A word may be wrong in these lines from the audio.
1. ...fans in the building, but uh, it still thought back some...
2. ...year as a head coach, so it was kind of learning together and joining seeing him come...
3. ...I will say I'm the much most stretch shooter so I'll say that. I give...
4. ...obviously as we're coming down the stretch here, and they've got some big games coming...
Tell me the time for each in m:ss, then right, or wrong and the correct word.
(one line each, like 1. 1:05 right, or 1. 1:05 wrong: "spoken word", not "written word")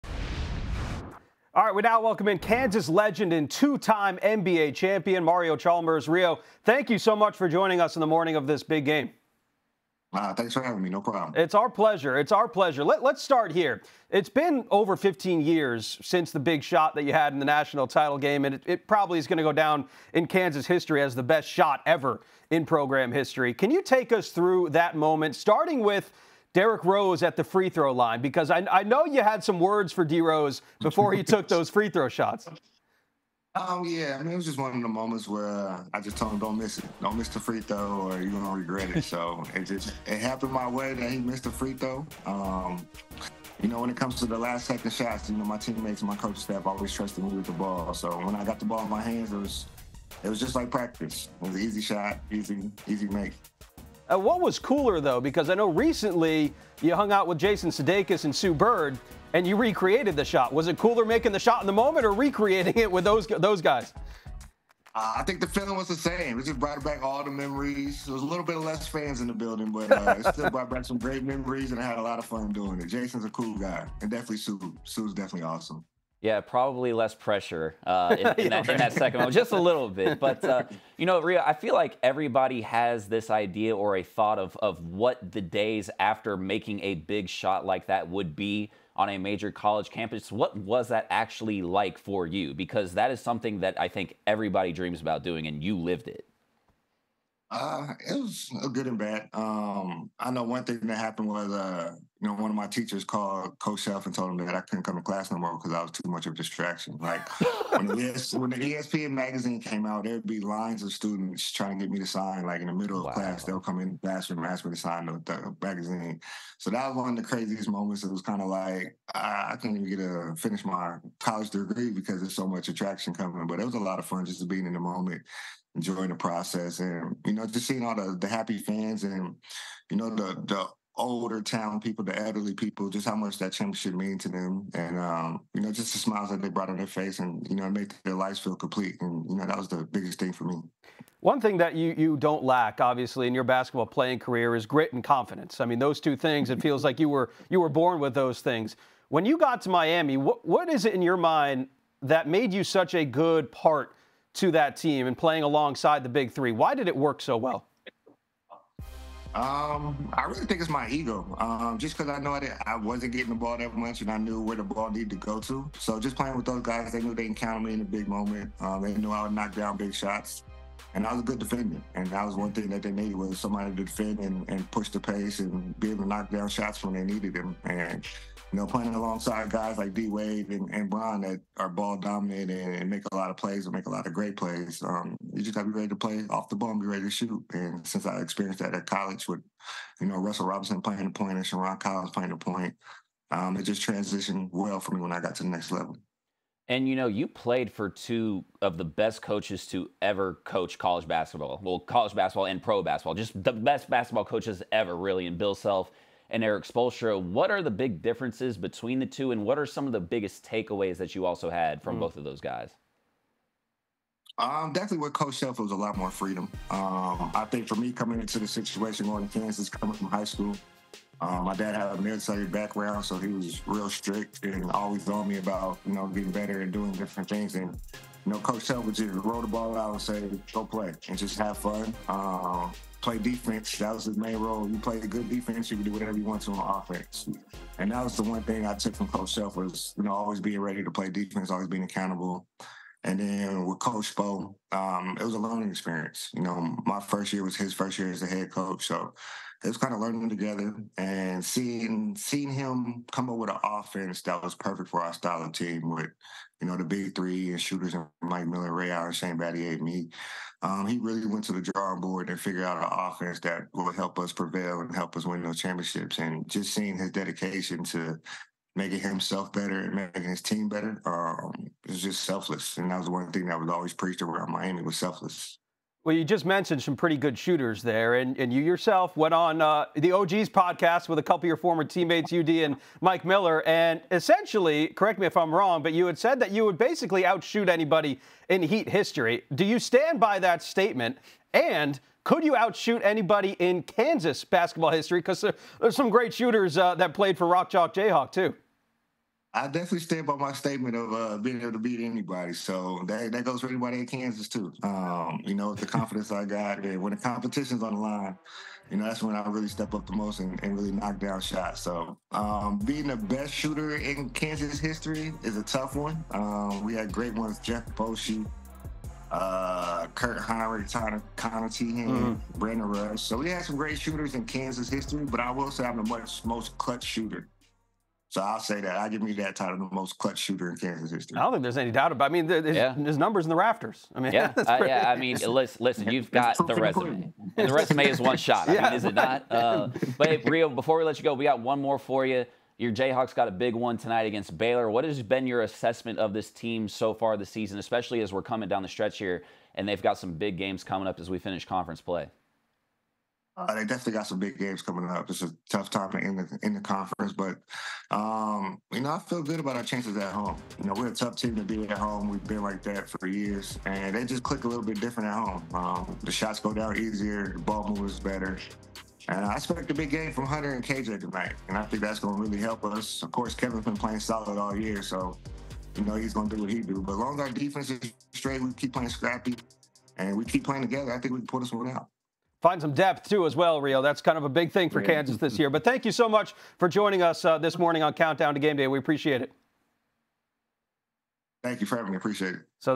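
1. 1:08 wrong: "brought", not "thought"
2. 4:07 wrong: "seeing", not "joining"
3. 5:25 wrong: "clutch", not "stretch"
4. 5:47 wrong: "especially", not "obviously".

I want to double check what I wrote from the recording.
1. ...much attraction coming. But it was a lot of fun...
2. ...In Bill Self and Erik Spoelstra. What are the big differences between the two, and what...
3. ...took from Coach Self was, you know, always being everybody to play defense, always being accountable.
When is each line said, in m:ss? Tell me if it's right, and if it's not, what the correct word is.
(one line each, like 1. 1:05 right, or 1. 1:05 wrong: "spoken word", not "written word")
1. 2:02 right
2. 3:25 right
3. 3:58 wrong: "ready", not "everybody".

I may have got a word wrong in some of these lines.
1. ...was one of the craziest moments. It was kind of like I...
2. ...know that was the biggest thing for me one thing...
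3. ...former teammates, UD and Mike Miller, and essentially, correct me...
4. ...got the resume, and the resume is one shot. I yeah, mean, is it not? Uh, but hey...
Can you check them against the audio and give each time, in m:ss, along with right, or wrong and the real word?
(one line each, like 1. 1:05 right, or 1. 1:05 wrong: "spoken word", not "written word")
1. 1:56 right
2. 2:19 right
3. 4:41 right
4. 5:36 right.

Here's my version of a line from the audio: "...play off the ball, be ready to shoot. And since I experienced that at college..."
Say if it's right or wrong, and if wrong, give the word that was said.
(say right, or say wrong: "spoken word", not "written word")
right.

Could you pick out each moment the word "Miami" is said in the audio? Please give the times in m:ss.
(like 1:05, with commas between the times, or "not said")
2:29, 4:34.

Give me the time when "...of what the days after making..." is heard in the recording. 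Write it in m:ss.
1:24.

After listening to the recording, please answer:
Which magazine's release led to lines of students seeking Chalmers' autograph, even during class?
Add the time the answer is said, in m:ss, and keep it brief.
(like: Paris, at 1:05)
ESPN magazine, at 1:48.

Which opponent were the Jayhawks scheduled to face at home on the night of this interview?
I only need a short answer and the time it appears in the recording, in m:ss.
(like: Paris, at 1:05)
Baylor, at 5:44.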